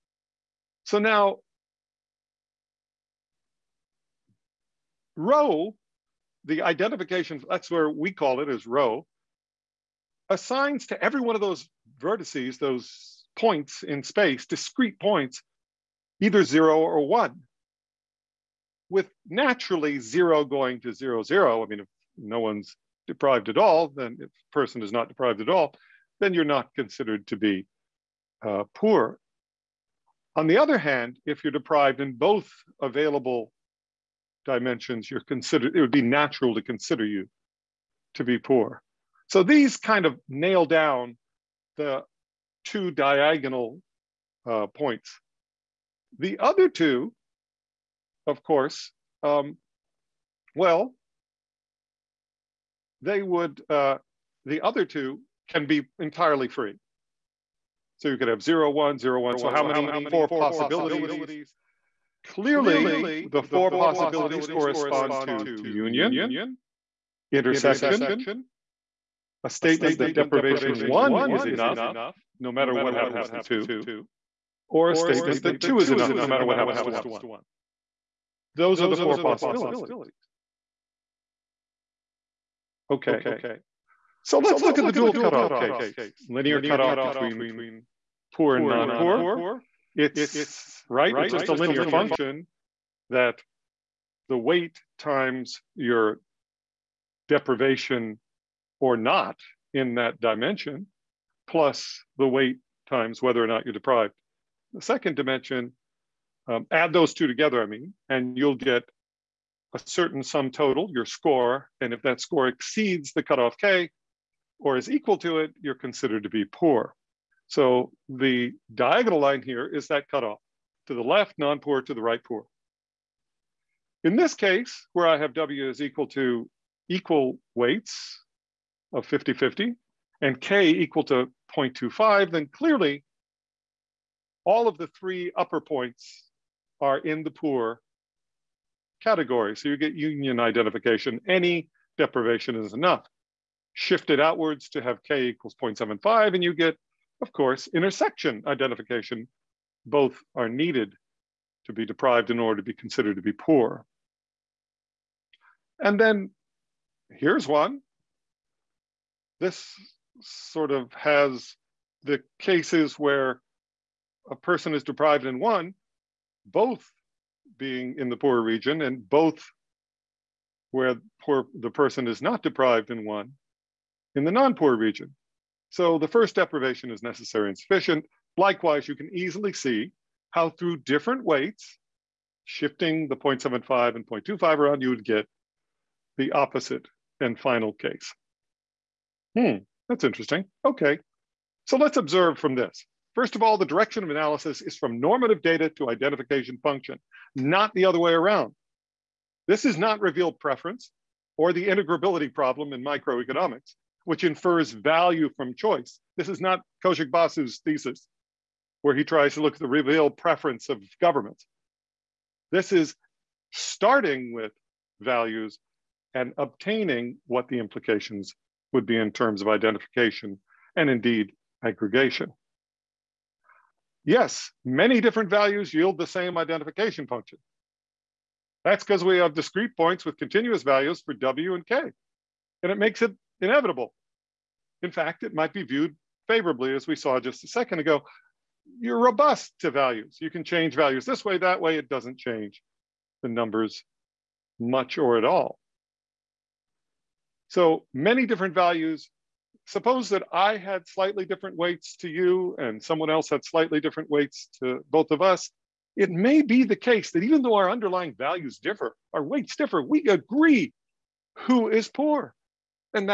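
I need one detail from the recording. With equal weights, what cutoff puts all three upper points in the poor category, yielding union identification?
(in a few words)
0.25.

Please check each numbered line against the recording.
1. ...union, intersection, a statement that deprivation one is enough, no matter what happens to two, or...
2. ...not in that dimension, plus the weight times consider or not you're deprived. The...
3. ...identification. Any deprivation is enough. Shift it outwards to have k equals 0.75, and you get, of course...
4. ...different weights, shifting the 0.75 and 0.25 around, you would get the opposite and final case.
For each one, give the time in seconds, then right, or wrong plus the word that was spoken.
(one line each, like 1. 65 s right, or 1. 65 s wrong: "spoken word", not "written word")
1. 65 s right
2. 98 s wrong: "whether", not "consider"
3. 140 s right
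4. 180 s right.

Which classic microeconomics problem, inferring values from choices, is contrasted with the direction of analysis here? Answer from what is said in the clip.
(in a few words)
integrability problem.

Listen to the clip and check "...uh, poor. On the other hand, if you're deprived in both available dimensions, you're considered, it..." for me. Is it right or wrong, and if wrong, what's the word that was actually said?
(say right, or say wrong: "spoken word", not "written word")
right.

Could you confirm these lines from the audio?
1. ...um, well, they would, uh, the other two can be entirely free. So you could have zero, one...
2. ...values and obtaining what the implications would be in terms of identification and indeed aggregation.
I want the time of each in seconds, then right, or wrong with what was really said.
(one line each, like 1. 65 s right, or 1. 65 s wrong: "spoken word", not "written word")
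1. 49 s right
2. 215 s right.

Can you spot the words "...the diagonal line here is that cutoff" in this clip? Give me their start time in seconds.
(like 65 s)
118 s.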